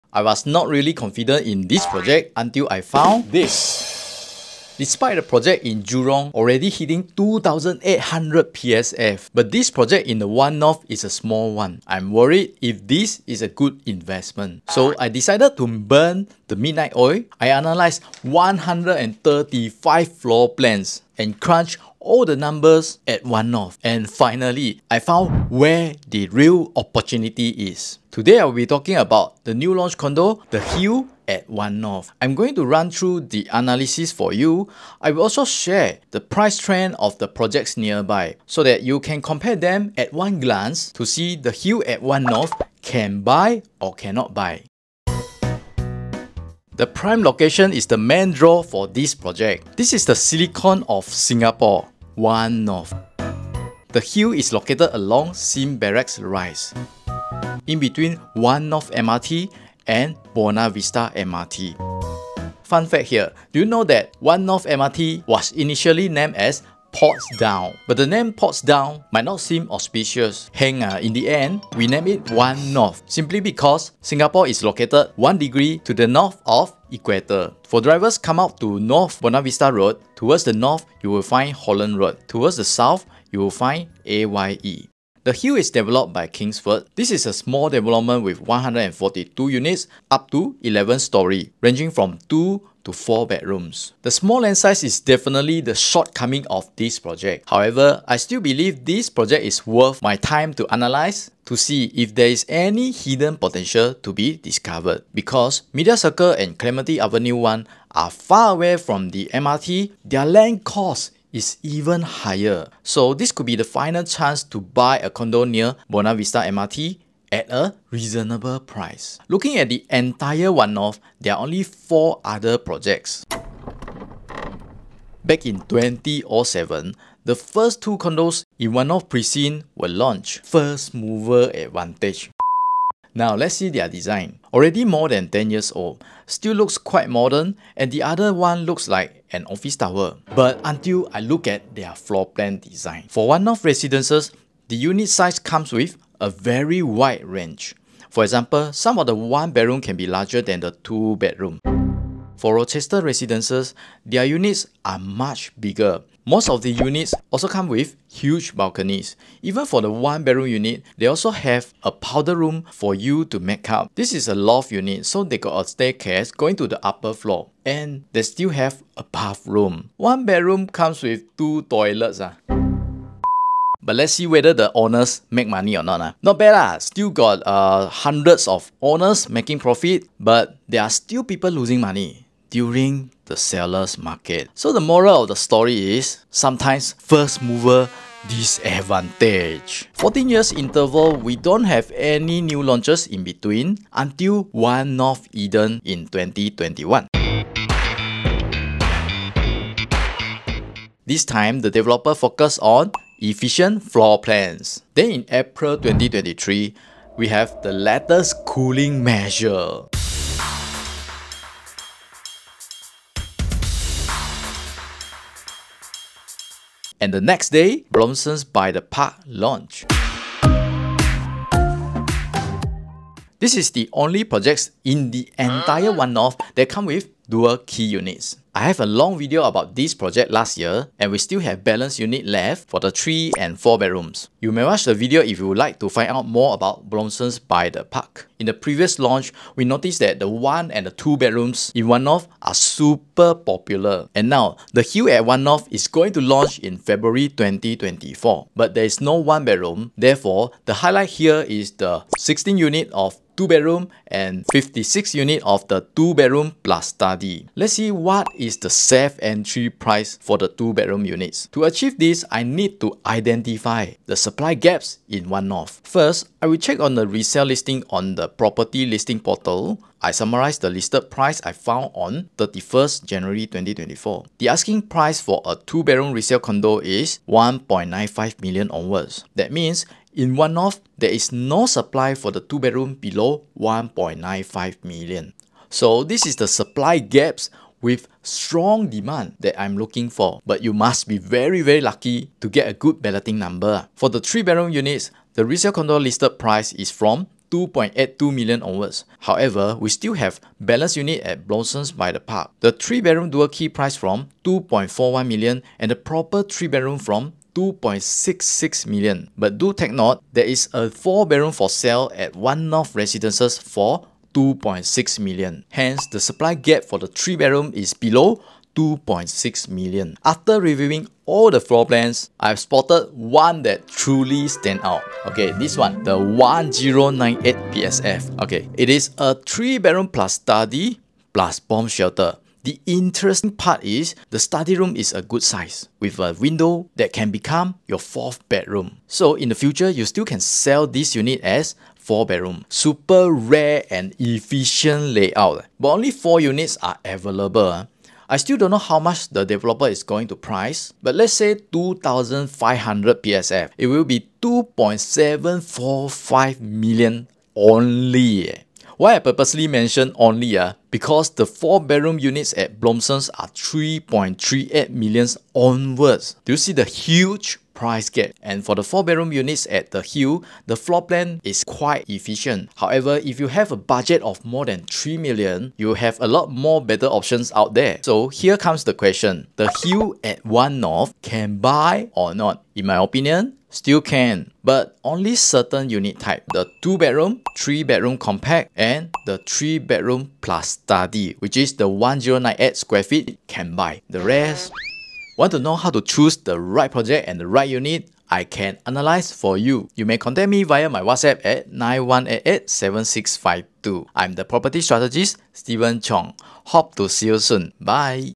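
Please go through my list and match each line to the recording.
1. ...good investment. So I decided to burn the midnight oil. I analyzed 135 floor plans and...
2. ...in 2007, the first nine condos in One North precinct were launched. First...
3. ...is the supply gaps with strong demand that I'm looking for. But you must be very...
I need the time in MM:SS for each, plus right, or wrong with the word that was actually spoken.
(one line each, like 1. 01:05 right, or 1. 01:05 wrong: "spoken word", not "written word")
1. 00:13 right
2. 02:05 wrong: "two", not "nine"
3. 04:46 right.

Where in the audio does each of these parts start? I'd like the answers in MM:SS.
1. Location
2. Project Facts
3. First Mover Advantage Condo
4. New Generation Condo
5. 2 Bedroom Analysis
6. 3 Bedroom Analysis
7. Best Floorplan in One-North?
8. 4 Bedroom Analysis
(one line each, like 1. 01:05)
1. 00:45
2. 01:25
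3. 01:58
4. 03:09
5. 04:04
6. 04:53
7. 05:20
8. 06:07.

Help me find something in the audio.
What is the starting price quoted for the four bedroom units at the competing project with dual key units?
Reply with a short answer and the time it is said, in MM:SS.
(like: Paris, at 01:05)
3.38 million, at 06:03.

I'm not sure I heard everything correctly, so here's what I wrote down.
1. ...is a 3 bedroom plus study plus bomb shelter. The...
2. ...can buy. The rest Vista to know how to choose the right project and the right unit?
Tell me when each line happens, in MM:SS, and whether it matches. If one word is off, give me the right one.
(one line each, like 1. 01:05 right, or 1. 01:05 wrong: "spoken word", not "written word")
1. 05:28 right
2. 06:33 wrong: "Want", not "Vista".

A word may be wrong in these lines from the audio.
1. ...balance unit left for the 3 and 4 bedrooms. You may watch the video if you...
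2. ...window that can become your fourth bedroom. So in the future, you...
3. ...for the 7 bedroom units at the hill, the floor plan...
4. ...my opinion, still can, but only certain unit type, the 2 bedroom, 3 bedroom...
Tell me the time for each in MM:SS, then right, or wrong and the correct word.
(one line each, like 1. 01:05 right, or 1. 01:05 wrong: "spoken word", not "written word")
1. 03:51 right
2. 05:36 right
3. 06:08 wrong: "4", not "7"
4. 06:22 right.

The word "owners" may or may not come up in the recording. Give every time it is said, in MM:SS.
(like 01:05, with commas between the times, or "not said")
02:54, 02:58.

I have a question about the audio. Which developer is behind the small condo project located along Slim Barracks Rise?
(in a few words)
Kingsford.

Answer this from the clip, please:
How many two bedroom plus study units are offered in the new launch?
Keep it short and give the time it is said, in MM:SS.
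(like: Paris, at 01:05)
56, at 04:14.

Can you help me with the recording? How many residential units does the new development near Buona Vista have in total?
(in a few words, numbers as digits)
142.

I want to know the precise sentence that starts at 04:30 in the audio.
I summarize the listed price I found on 31st January 2024.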